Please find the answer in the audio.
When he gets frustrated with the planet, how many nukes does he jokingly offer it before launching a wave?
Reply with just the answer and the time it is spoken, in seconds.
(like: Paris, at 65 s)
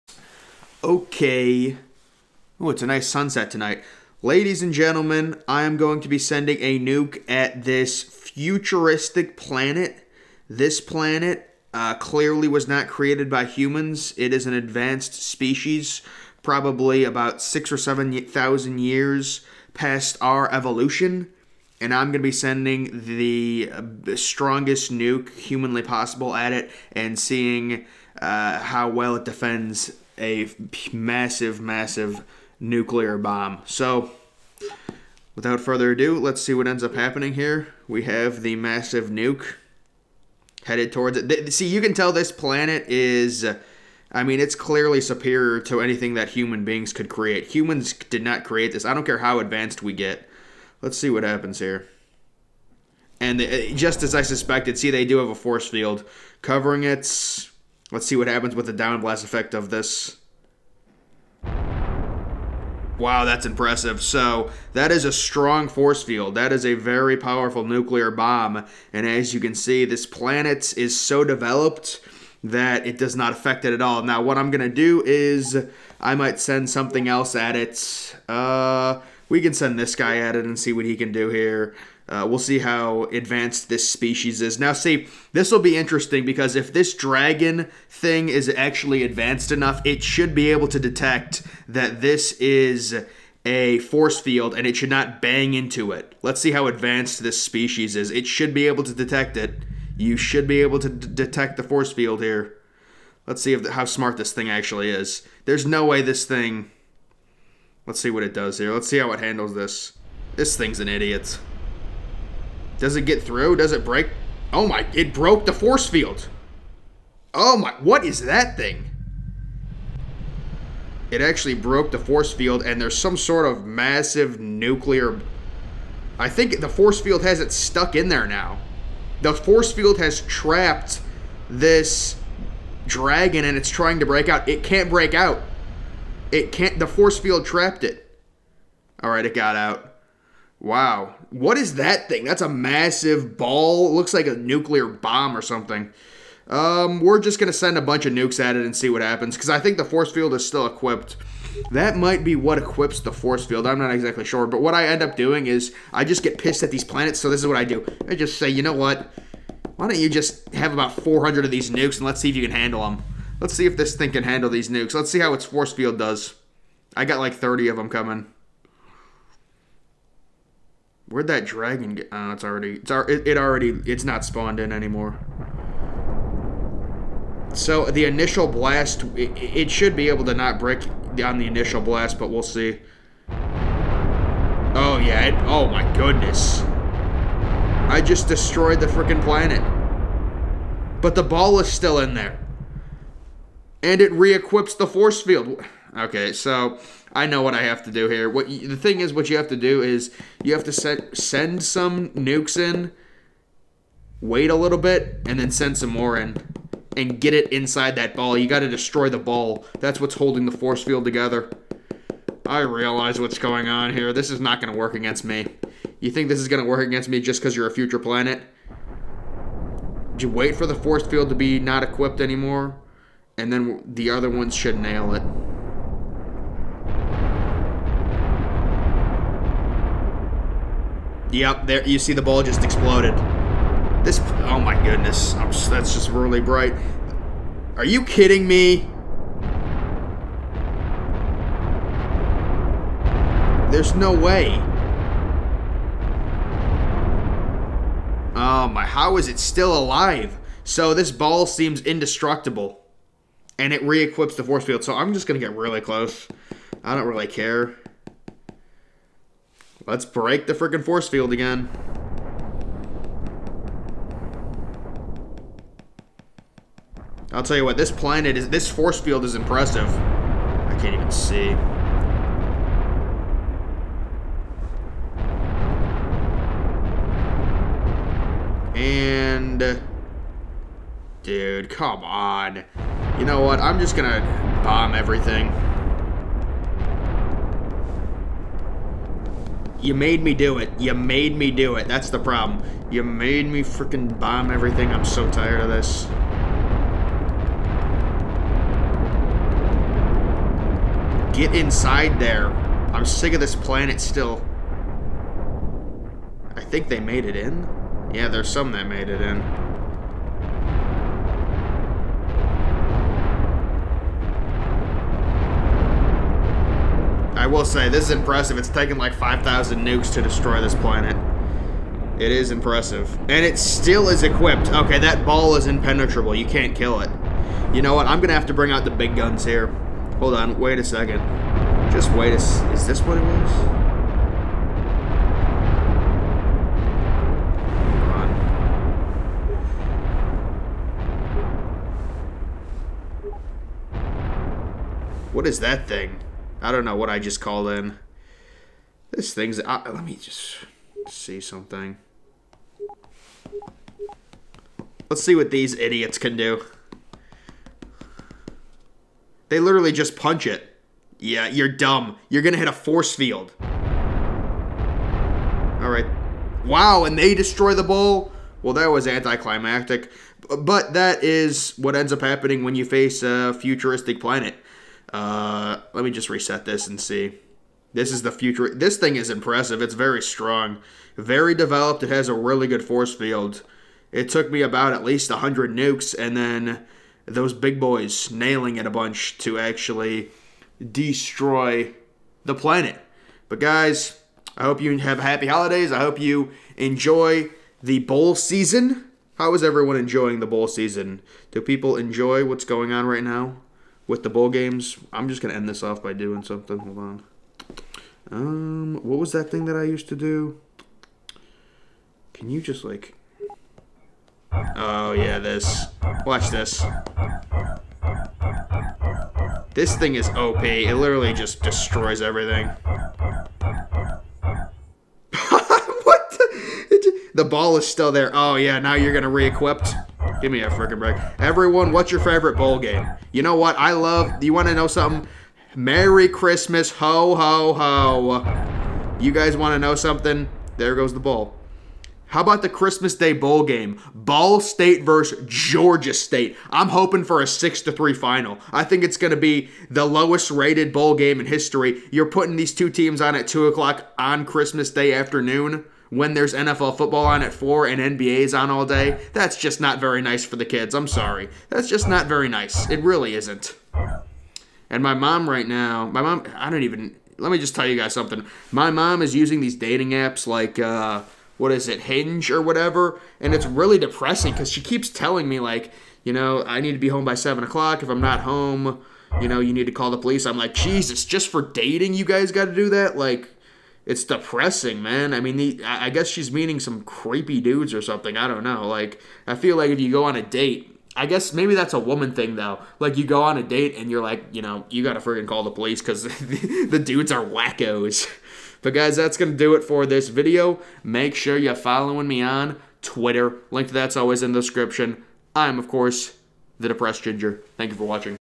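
400, at 160 s.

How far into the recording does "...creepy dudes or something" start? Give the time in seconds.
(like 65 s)
487 s.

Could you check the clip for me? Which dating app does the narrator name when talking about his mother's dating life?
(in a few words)
Hinge.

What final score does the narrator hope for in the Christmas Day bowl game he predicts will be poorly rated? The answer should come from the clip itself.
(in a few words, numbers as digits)
6 to 3.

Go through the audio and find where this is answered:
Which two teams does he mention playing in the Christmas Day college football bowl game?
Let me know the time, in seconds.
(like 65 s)
444 s.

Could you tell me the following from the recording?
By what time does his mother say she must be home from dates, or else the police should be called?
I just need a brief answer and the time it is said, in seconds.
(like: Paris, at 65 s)
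7 o'clock, at 477 s.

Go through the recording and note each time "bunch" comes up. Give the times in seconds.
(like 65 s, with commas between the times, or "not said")
147 s, 388 s.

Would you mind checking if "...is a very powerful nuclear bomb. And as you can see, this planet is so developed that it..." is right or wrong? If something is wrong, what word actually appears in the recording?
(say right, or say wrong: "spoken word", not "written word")
right.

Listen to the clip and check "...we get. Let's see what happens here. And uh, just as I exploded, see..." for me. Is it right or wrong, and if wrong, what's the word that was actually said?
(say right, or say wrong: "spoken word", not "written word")
wrong: "suspected", not "exploded".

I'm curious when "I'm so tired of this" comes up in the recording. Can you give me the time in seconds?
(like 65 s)
294 s.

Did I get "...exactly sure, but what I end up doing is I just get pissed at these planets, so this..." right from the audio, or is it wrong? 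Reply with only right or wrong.
right.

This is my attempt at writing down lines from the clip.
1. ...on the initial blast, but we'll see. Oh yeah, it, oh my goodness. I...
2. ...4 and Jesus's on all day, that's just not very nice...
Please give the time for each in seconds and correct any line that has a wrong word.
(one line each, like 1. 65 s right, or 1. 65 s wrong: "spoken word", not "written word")
1. 181 s right
2. 457 s wrong: "NBA", not "Jesus".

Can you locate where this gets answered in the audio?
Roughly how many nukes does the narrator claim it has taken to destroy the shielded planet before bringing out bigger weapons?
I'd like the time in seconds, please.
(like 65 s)
319 s.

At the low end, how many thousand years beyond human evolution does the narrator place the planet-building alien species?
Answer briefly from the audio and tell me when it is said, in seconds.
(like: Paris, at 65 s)
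6, at 17 s.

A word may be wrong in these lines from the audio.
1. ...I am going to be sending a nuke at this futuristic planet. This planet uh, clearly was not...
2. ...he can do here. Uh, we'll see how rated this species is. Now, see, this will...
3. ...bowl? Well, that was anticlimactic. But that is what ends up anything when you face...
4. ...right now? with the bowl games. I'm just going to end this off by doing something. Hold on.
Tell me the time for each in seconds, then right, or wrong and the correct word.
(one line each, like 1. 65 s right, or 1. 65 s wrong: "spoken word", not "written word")
1. 5 s right
2. 80 s wrong: "advanced", not "rated"
3. 367 s wrong: "happening", not "anything"
4. 403 s right.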